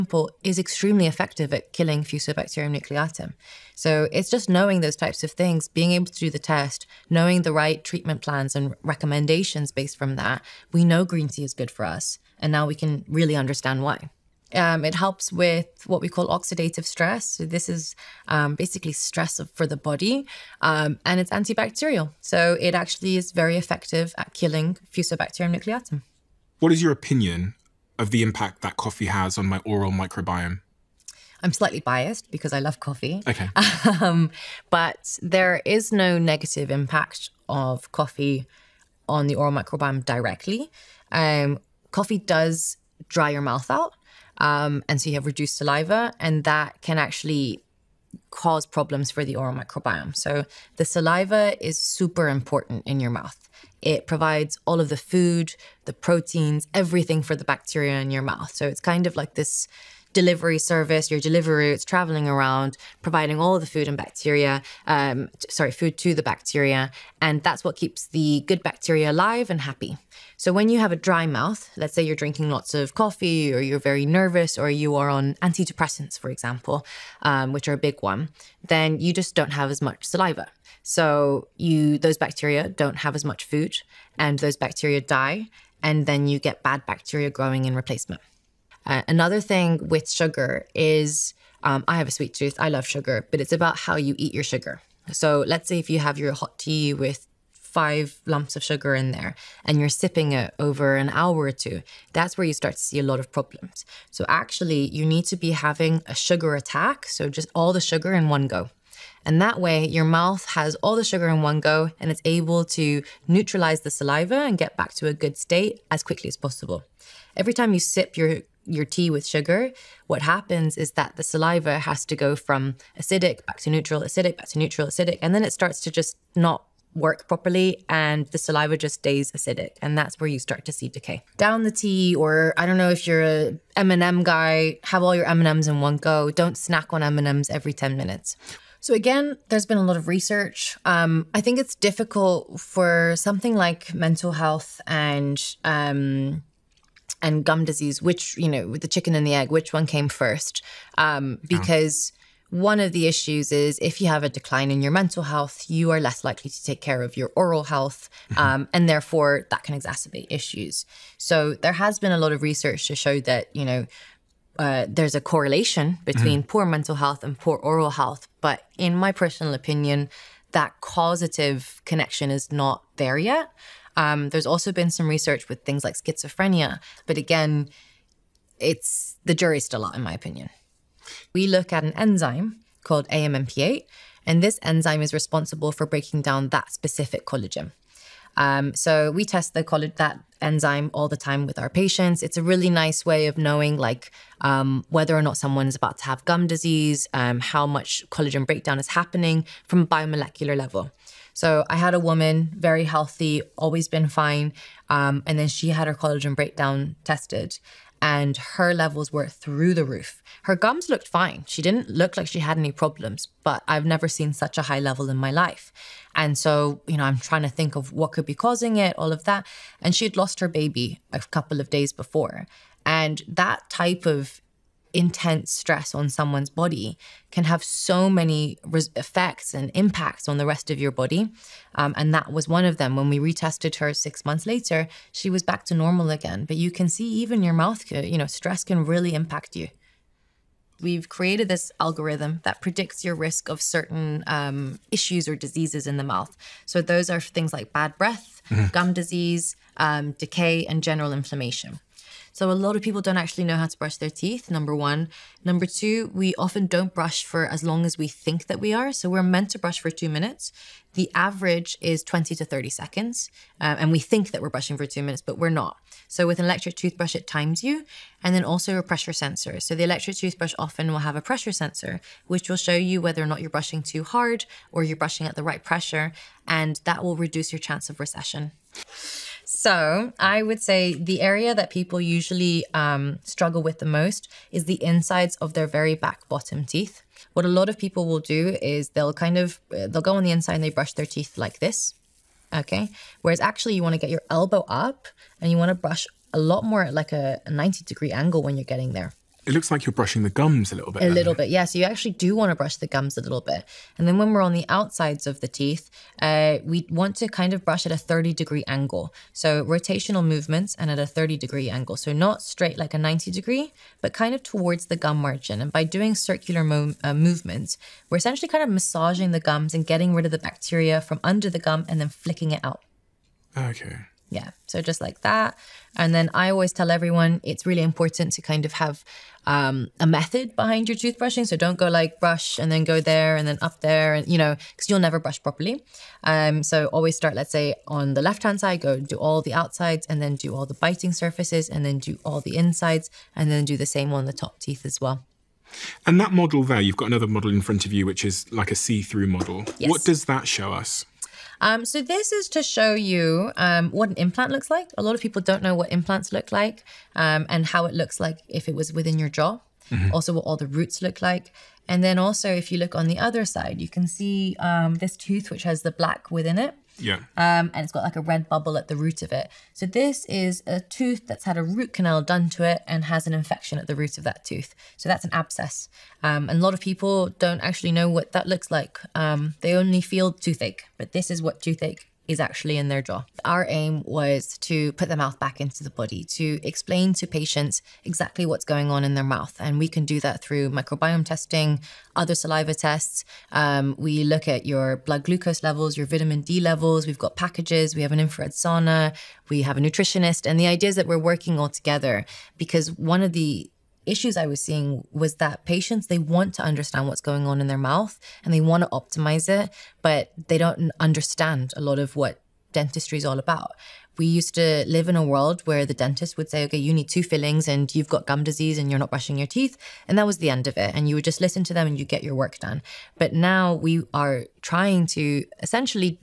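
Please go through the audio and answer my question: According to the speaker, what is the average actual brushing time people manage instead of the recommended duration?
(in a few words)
20 to 30 seconds.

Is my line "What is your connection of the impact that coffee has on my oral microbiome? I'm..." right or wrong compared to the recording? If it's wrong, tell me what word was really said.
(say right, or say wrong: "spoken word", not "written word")
wrong: "opinion", not "connection".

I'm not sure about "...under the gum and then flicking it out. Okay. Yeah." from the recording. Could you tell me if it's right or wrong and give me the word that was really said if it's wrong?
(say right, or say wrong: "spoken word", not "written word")
right.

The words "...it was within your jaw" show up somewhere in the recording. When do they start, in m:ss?
5:58.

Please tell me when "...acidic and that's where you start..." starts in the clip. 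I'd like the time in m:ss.
2:09.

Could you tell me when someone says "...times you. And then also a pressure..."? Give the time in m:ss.
4:27.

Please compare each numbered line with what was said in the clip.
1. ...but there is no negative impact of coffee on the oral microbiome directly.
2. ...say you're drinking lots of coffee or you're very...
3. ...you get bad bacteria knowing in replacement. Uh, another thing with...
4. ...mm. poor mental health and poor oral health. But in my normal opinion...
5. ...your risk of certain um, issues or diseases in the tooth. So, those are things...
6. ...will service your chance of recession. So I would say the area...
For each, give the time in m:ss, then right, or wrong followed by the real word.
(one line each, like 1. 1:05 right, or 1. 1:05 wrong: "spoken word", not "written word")
1. 0:34 right
2. 1:11 right
3. 1:26 wrong: "growing", not "knowing"
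4. 2:46 wrong: "personal", not "normal"
5. 4:03 wrong: "mouth", not "tooth"
6. 4:37 wrong: "reduce", not "service".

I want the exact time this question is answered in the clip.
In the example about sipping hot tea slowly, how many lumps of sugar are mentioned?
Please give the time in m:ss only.
1:37.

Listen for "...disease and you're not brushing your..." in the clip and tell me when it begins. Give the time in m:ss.
6:58.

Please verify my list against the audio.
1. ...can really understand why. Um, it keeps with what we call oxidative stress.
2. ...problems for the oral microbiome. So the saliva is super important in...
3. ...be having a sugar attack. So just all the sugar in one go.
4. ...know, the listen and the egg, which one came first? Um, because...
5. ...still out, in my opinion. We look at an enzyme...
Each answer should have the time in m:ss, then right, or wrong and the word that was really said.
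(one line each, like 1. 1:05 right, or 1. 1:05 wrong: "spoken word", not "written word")
1. 0:12 wrong: "helps", not "keeps"
2. 0:48 right
3. 1:45 right
4. 2:28 wrong: "chicken", not "listen"
5. 2:59 right.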